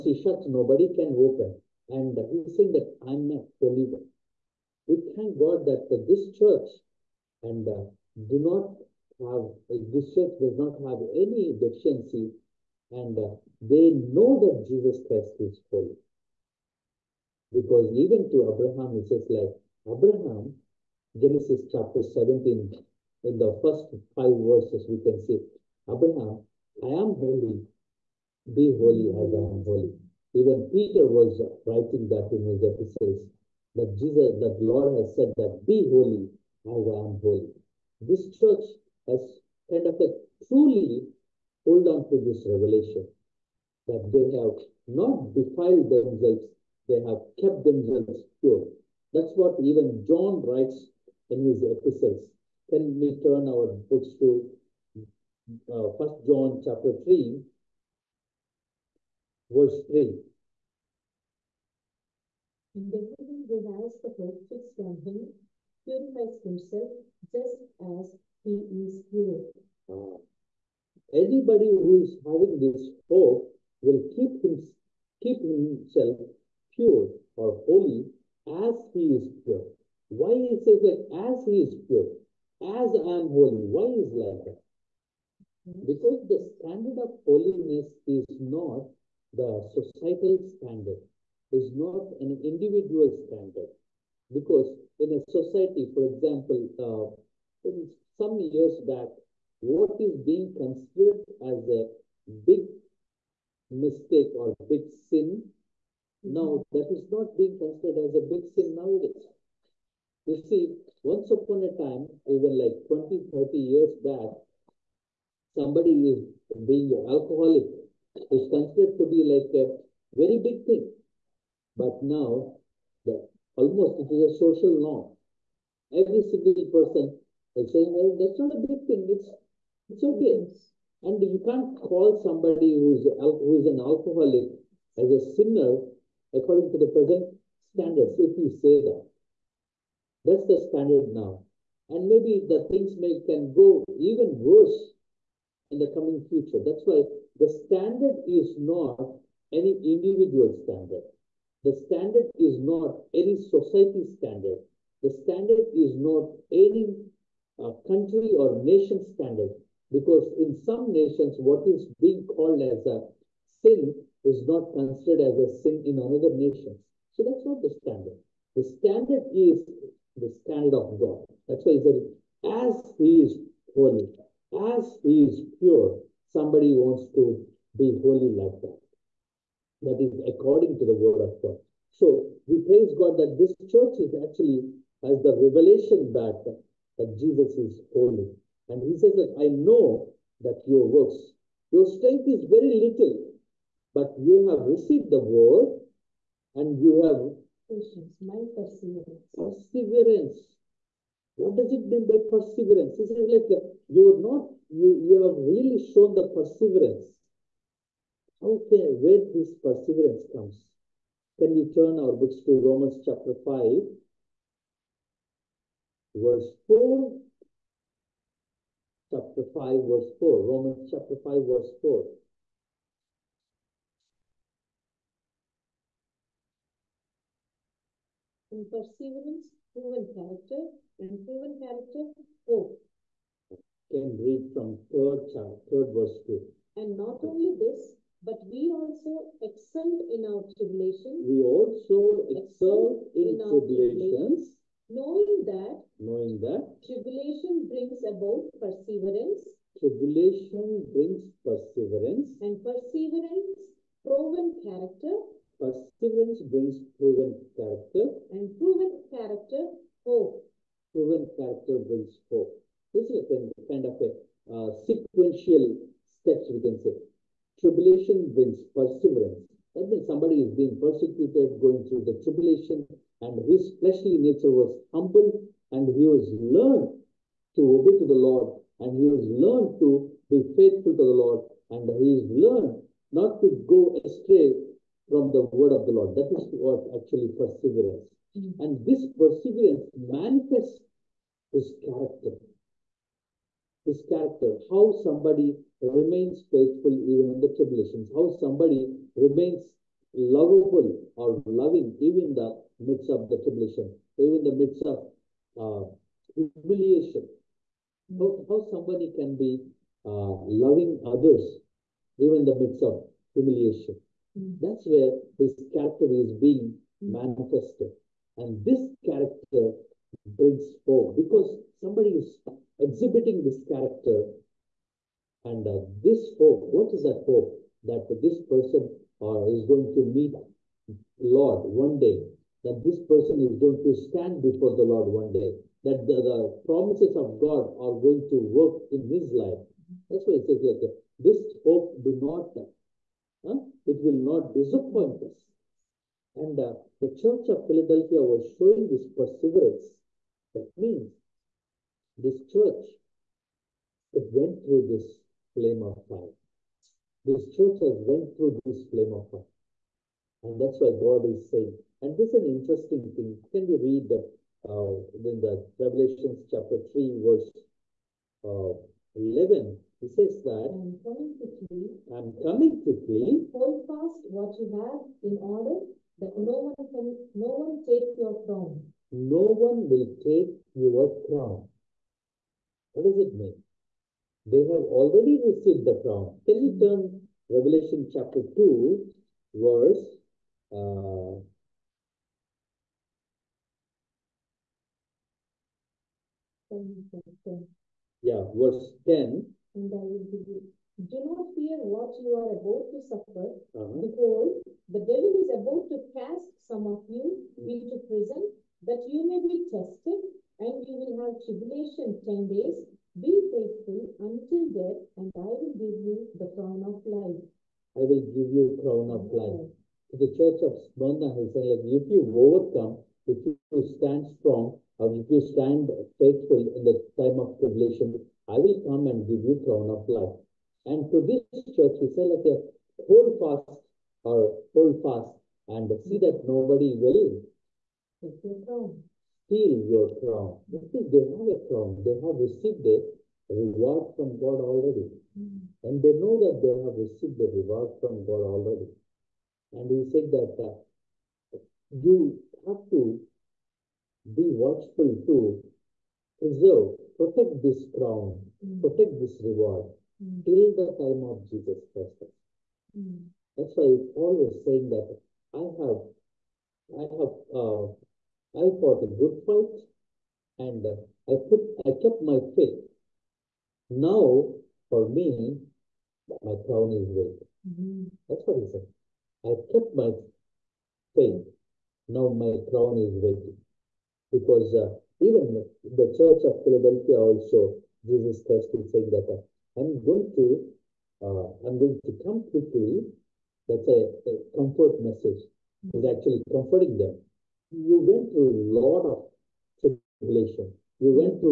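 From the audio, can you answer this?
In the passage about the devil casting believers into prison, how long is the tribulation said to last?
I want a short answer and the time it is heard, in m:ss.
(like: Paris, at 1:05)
10 days, at 6:52.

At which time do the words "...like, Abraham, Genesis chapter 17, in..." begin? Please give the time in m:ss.
0:19.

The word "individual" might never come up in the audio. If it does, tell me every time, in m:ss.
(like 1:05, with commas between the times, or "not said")
1:32, 2:29.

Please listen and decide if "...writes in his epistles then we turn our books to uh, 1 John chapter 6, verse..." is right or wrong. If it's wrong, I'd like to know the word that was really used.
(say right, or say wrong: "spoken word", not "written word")
wrong: "3", not "6".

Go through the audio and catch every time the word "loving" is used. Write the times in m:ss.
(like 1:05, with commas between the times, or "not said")
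5:01, 5:10.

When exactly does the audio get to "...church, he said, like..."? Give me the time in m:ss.
7:11.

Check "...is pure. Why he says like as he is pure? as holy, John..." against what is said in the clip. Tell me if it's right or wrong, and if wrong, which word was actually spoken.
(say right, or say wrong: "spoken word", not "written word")
wrong: "Why", not "John".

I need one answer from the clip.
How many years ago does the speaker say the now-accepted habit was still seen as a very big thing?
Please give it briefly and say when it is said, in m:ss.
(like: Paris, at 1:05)
20 to 30 years, at 1:52.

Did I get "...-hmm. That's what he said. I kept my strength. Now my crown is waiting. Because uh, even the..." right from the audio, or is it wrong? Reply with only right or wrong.
wrong.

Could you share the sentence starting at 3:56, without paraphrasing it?
And not only this, but we also excel in our tribulation.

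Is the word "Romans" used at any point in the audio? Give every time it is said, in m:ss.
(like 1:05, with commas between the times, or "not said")
3:32, 3:40.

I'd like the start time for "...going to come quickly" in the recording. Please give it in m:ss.
8:11.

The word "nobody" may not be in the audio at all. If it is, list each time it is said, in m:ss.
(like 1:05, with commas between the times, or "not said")
0:00, 7:16.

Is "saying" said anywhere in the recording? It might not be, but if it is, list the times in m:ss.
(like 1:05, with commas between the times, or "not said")
0:02, 2:07, 6:01, 7:44, 8:08.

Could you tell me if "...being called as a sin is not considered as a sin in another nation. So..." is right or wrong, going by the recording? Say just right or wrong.
right.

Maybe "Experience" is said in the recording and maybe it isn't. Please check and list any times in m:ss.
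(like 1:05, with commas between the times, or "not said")
4:16.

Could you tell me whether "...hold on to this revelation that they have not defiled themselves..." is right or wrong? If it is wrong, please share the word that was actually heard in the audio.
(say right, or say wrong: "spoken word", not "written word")
right.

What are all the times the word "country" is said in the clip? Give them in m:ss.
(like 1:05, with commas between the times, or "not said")
2:37.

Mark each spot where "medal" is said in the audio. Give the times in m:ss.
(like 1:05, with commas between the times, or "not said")
not said.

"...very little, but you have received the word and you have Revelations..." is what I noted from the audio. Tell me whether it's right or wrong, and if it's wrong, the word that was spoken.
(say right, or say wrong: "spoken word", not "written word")
wrong: "Patience", not "Revelations".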